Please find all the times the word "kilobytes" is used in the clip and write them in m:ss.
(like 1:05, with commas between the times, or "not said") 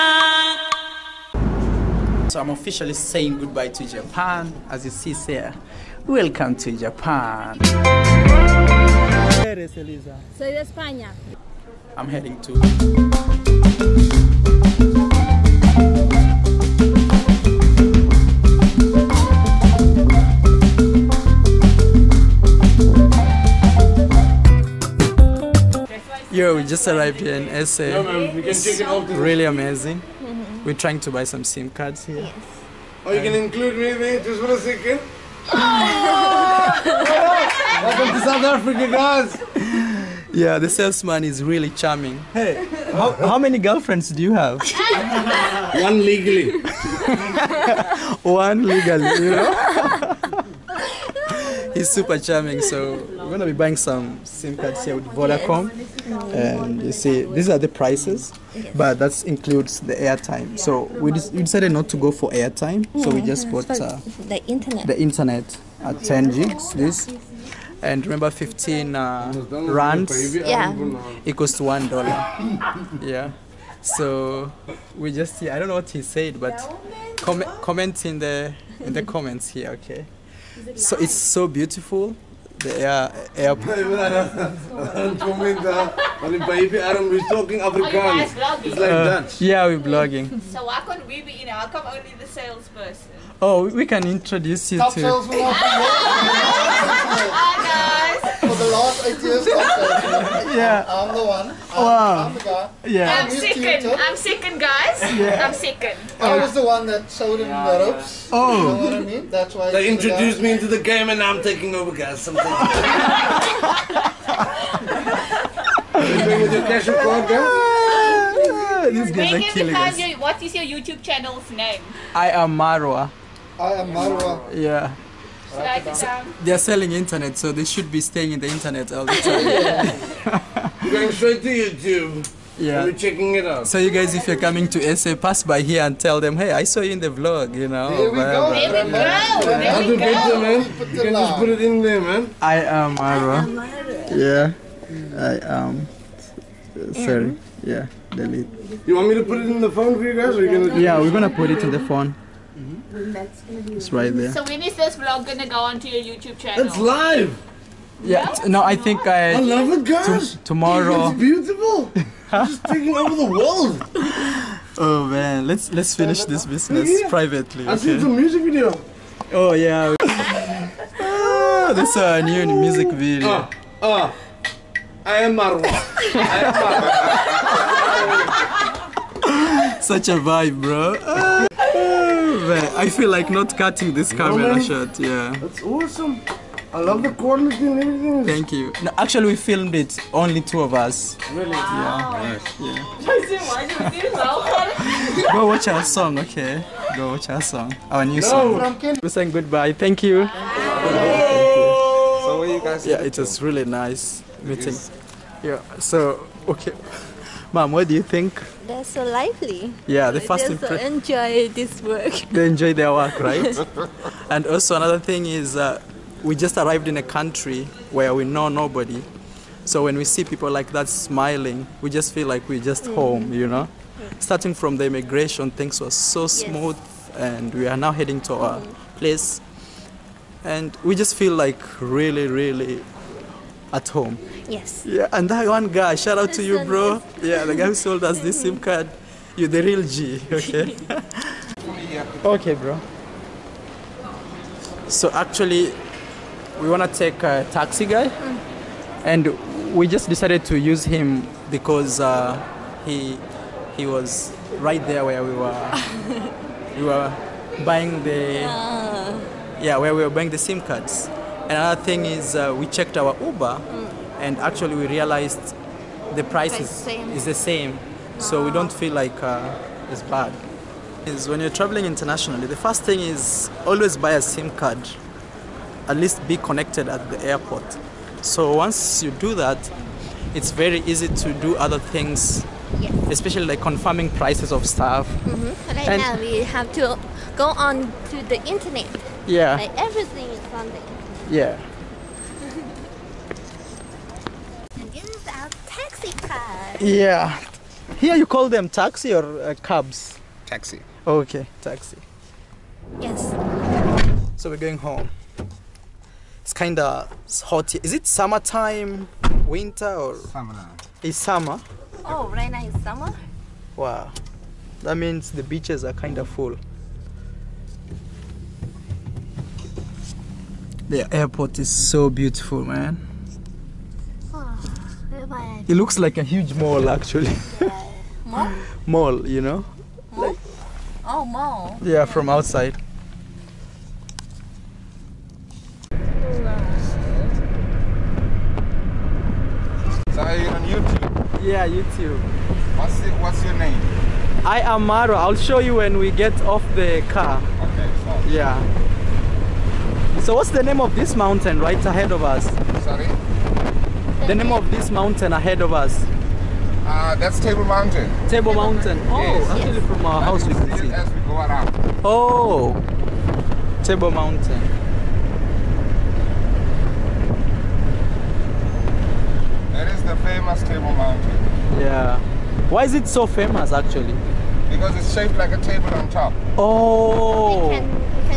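not said.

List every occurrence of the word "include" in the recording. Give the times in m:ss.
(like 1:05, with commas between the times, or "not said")
0:33, 0:59.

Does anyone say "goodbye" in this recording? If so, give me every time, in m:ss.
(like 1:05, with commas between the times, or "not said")
0:03, 3:19.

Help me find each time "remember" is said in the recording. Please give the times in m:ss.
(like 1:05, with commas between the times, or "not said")
1:08.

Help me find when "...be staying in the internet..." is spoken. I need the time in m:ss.
2:07.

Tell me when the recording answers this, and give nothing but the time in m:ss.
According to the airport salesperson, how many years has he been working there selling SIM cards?
1:39.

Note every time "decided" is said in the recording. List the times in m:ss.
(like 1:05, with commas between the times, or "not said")
1:01, 4:10.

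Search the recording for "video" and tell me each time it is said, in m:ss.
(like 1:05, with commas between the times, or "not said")
2:48, 2:52.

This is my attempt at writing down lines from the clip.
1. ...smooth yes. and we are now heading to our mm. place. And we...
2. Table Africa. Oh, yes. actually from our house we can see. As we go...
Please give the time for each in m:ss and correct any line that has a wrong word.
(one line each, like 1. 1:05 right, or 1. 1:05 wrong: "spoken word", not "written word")
1. 3:46 right
2. 5:58 wrong: "Mountain", not "Africa".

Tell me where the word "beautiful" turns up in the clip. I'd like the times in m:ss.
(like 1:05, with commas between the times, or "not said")
1:21, 2:41, 5:22.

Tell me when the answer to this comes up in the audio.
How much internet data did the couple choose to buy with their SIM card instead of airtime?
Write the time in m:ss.
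1:06.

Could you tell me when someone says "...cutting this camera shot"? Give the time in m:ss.
3:03.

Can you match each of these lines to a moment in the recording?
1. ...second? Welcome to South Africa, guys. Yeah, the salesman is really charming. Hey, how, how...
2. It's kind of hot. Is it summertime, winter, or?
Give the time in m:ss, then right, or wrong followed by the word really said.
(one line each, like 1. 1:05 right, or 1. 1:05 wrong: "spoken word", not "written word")
1. 0:34 right
2. 5:06 right.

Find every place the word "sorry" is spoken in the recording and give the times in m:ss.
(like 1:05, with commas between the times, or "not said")
2:27, 5:52.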